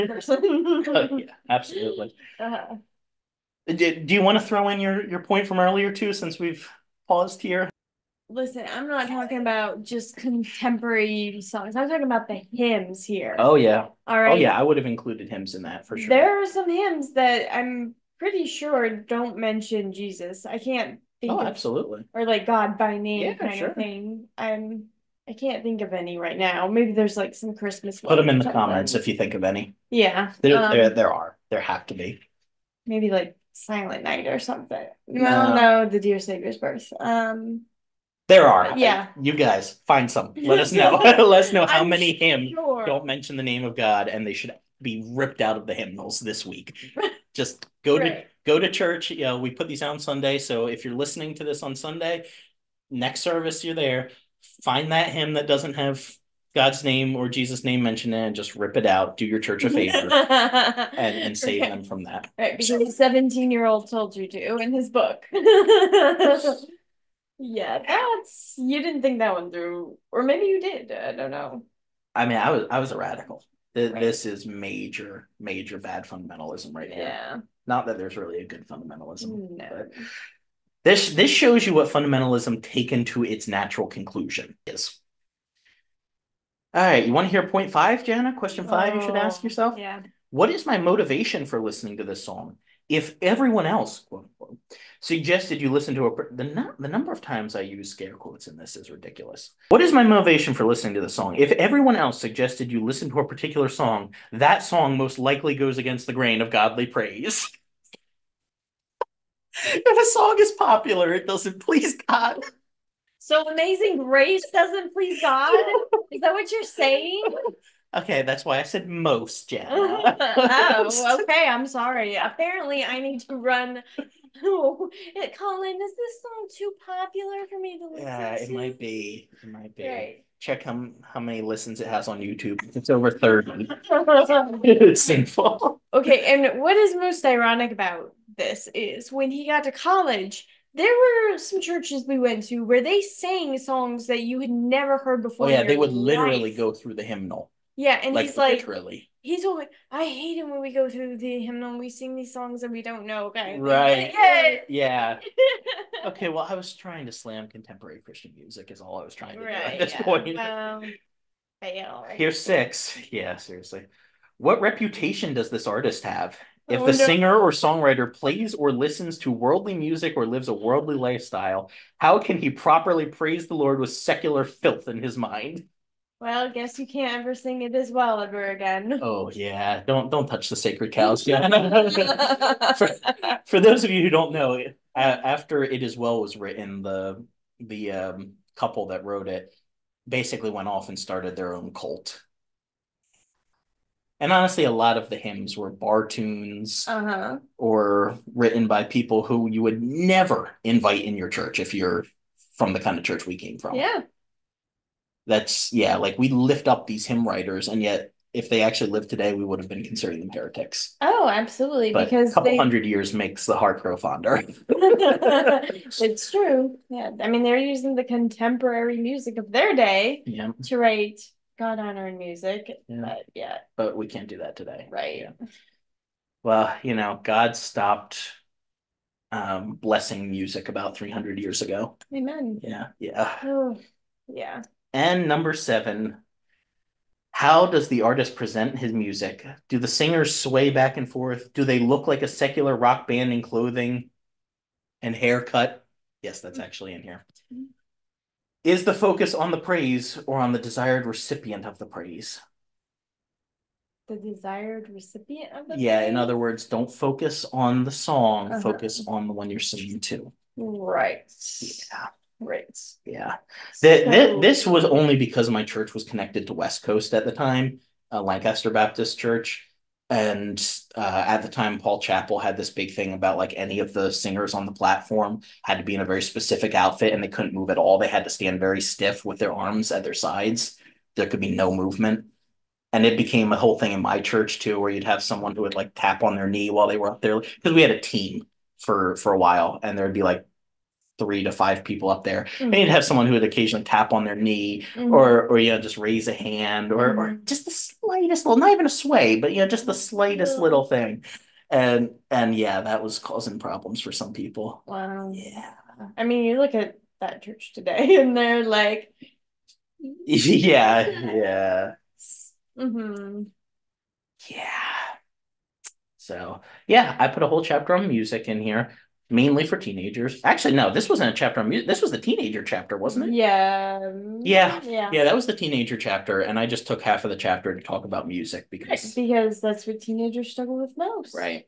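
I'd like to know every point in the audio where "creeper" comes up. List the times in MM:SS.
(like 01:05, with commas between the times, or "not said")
not said.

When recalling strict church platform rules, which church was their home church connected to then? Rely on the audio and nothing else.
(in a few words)
Lancaster Baptist Church.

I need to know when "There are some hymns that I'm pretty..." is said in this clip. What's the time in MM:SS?
00:16.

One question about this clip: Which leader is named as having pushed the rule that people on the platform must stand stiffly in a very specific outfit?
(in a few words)
Paul Chappell.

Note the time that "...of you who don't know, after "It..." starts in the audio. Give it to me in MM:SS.
03:03.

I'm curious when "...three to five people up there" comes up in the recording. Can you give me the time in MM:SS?
04:51.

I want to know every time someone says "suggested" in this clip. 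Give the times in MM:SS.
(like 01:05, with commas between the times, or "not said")
01:35, 01:42.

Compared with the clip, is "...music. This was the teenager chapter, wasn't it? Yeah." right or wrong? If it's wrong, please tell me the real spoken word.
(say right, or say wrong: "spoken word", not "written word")
right.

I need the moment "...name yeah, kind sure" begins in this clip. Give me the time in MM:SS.
00:22.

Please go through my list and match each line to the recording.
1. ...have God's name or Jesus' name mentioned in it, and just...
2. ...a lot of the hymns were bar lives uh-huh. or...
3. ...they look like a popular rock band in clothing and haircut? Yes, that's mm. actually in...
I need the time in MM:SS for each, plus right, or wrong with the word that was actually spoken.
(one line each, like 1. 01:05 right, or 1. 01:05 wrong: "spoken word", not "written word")
1. 00:55 right
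2. 03:14 wrong: "tunes", not "lives"
3. 04:01 wrong: "secular", not "popular".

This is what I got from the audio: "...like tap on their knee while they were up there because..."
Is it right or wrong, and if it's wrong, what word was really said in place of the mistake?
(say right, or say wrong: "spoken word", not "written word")
right.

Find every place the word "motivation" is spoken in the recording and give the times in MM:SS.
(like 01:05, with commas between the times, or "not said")
01:30, 01:40.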